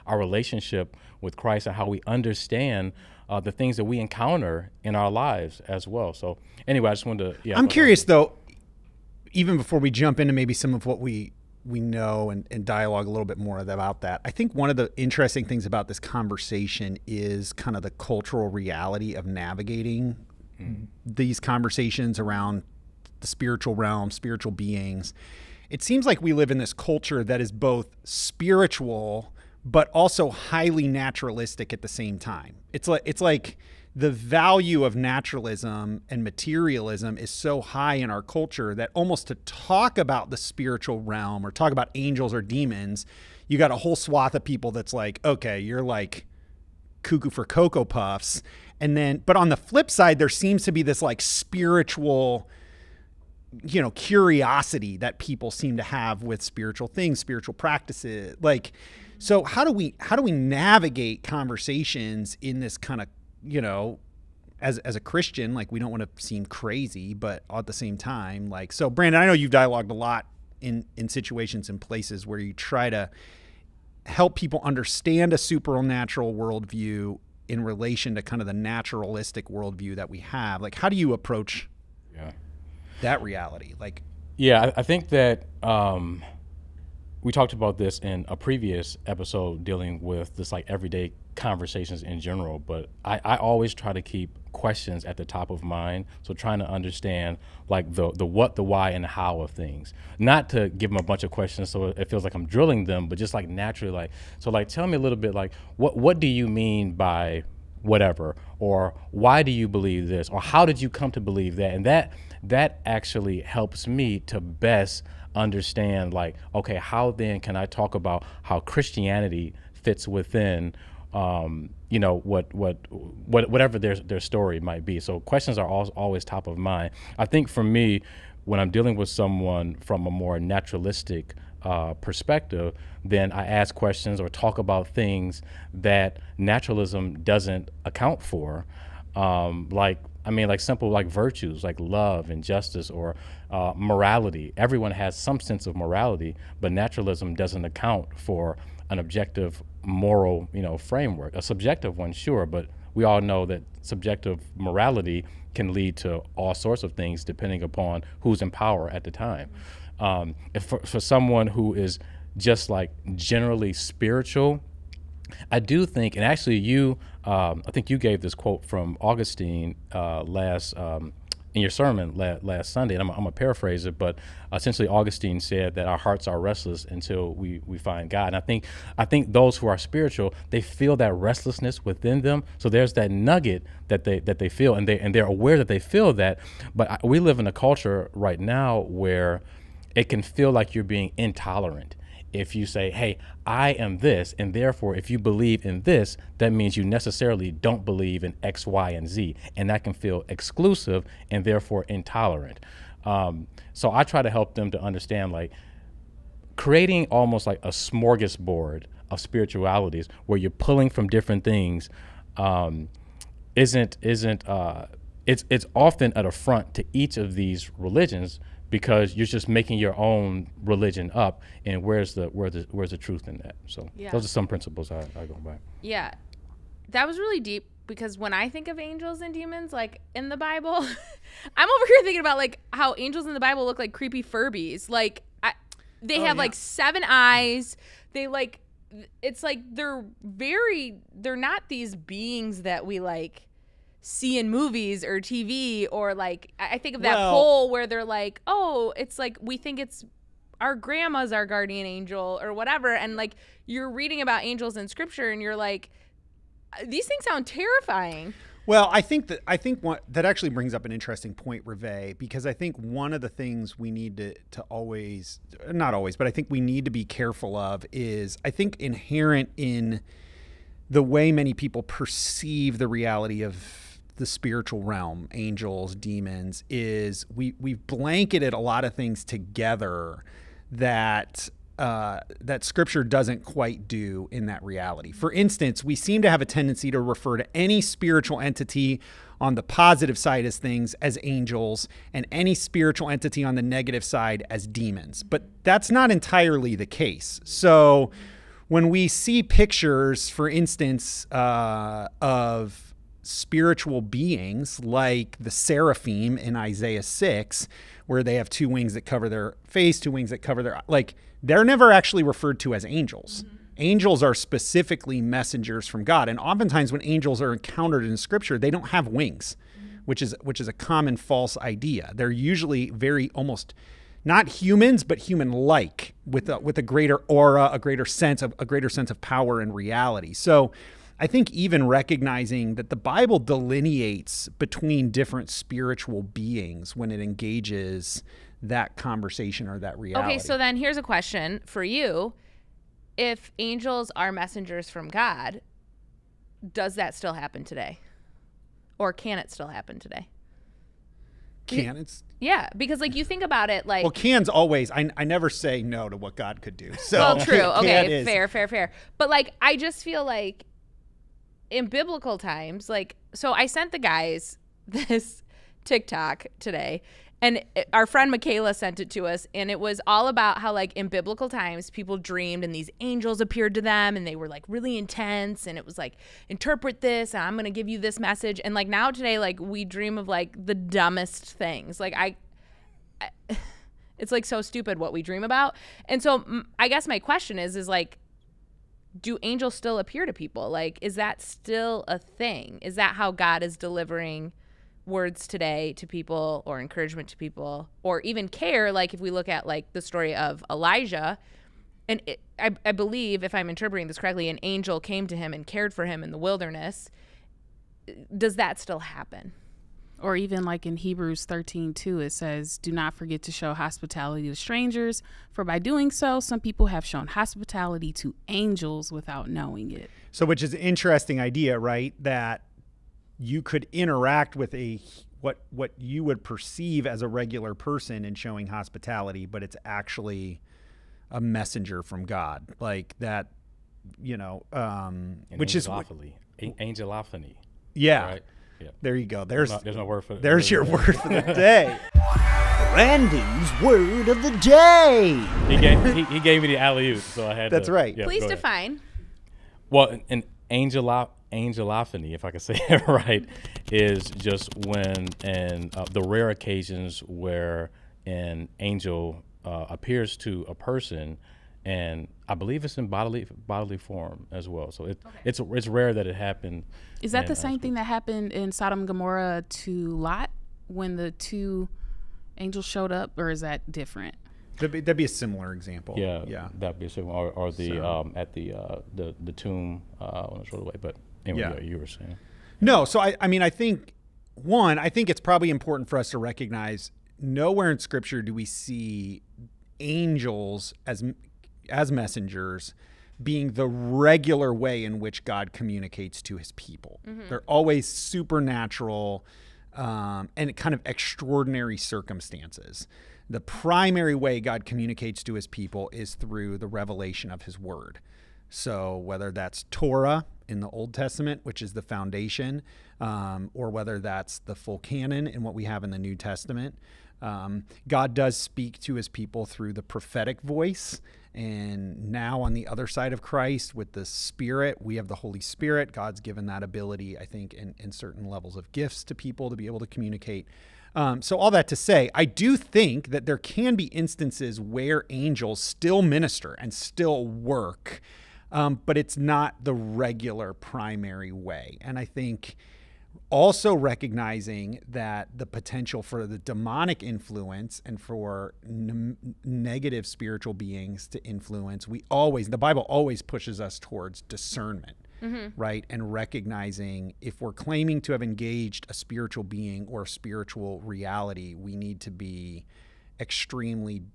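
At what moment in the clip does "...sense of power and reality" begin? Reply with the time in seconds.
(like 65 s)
328 s.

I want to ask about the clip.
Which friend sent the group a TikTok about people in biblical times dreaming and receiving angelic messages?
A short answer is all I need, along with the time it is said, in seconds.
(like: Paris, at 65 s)
Michaela, at 368 s.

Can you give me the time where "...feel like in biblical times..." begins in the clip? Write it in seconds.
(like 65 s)
360 s.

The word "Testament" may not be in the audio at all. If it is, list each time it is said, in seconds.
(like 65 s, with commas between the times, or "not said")
511 s, 516 s.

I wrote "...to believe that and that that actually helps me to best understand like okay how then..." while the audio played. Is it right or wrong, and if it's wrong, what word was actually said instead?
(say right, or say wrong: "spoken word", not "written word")
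right.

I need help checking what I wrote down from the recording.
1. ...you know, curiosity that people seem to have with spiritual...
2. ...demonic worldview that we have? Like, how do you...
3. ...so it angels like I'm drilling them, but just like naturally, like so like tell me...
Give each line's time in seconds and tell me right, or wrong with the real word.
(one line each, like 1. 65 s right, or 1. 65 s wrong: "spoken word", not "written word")
1. 53 s right
2. 78 s wrong: "naturalistic", not "demonic"
3. 101 s wrong: "feels", not "angels".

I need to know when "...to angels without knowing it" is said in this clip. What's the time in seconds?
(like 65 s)
418 s.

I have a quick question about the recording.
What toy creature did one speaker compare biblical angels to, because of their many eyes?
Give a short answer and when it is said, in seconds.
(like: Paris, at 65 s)
Furbies, at 234 s.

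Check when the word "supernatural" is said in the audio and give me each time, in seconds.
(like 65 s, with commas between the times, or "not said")
75 s, 498 s.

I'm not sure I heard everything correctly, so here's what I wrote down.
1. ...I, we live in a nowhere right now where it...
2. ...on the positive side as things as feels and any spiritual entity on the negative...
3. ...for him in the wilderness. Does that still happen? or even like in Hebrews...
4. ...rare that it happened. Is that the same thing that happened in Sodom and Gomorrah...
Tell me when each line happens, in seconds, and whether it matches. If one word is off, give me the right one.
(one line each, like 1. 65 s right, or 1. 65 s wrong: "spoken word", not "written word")
1. 186 s wrong: "culture", not "nowhere"
2. 289 s wrong: "angels", not "feels"
3. 405 s right
4. 465 s right.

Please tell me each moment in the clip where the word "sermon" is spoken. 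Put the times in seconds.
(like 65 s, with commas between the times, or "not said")
171 s.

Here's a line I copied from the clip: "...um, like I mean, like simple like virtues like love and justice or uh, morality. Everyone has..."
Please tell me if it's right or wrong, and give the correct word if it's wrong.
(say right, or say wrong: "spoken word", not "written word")
right.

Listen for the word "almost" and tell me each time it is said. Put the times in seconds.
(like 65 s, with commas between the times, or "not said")
38 s, 207 s, 323 s.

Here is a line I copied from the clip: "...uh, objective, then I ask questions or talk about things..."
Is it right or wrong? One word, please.
wrong.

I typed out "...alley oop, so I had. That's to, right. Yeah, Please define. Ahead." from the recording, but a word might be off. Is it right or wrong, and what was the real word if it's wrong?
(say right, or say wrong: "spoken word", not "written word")
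right.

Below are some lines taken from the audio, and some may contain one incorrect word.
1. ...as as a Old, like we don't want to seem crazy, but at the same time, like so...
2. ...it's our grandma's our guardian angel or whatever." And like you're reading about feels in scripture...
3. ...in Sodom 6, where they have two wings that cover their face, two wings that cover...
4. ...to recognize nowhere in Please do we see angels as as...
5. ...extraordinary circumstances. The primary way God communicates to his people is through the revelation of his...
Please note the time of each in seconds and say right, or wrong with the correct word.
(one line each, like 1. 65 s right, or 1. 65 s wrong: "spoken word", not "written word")
1. 64 s wrong: "Christian", not "Old"
2. 249 s wrong: "angels", not "feels"
3. 306 s wrong: "Isaiah", not "Sodom"
4. 486 s wrong: "Scripture", not "Please"
5. 501 s right.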